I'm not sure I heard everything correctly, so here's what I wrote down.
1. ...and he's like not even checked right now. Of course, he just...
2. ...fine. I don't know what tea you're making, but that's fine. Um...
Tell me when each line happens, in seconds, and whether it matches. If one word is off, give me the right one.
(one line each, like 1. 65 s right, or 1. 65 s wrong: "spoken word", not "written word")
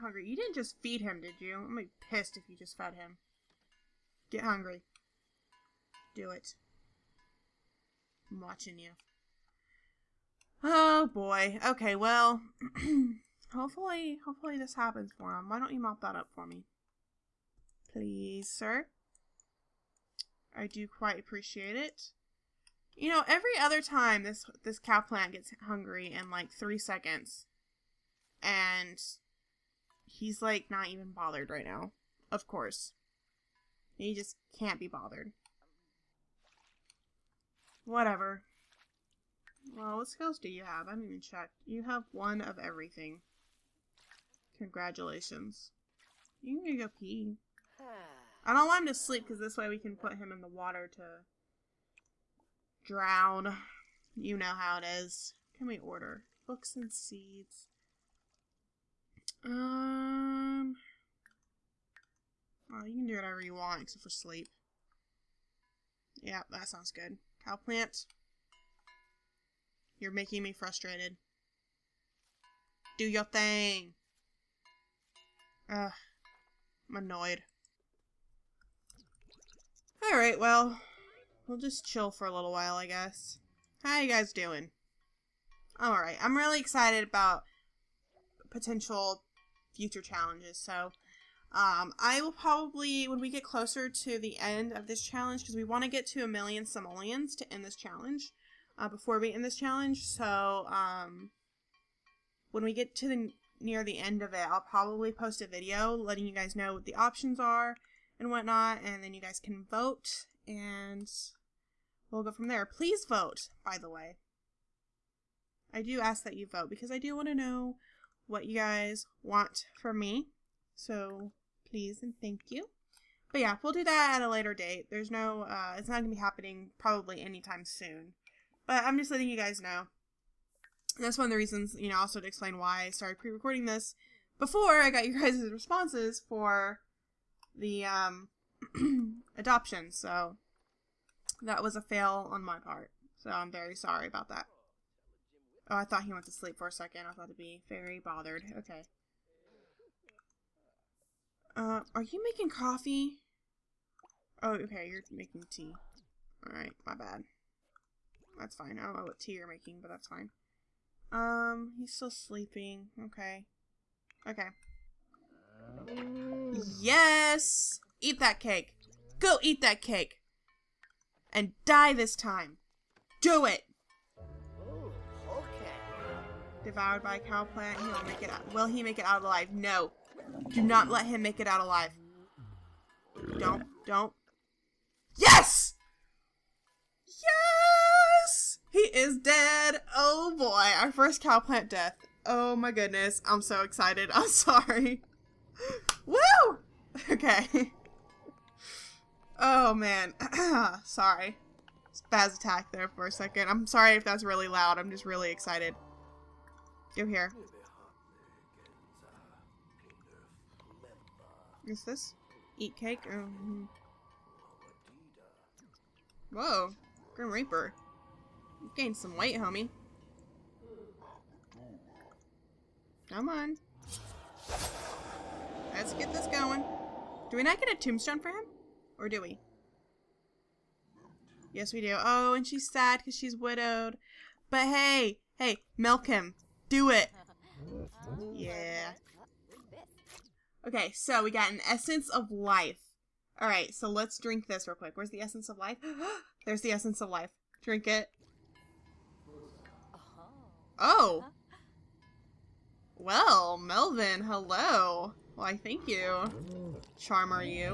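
1. 28 s wrong: "bothered", not "checked"
2. 158 s right.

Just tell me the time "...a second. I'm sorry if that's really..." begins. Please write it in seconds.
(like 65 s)
203 s.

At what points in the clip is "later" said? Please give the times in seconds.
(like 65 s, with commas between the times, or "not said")
124 s.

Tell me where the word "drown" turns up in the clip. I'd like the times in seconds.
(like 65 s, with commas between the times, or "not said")
52 s.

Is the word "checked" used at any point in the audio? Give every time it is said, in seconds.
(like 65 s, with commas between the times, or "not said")
41 s.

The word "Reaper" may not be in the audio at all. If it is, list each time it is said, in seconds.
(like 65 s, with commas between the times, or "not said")
217 s.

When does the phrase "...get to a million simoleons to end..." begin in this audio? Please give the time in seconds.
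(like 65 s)
95 s.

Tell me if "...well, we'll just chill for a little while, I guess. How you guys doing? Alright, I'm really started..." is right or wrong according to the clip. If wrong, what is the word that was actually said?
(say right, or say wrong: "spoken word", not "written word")
wrong: "excited", not "started".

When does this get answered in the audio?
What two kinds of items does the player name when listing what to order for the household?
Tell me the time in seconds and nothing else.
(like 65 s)
56 s.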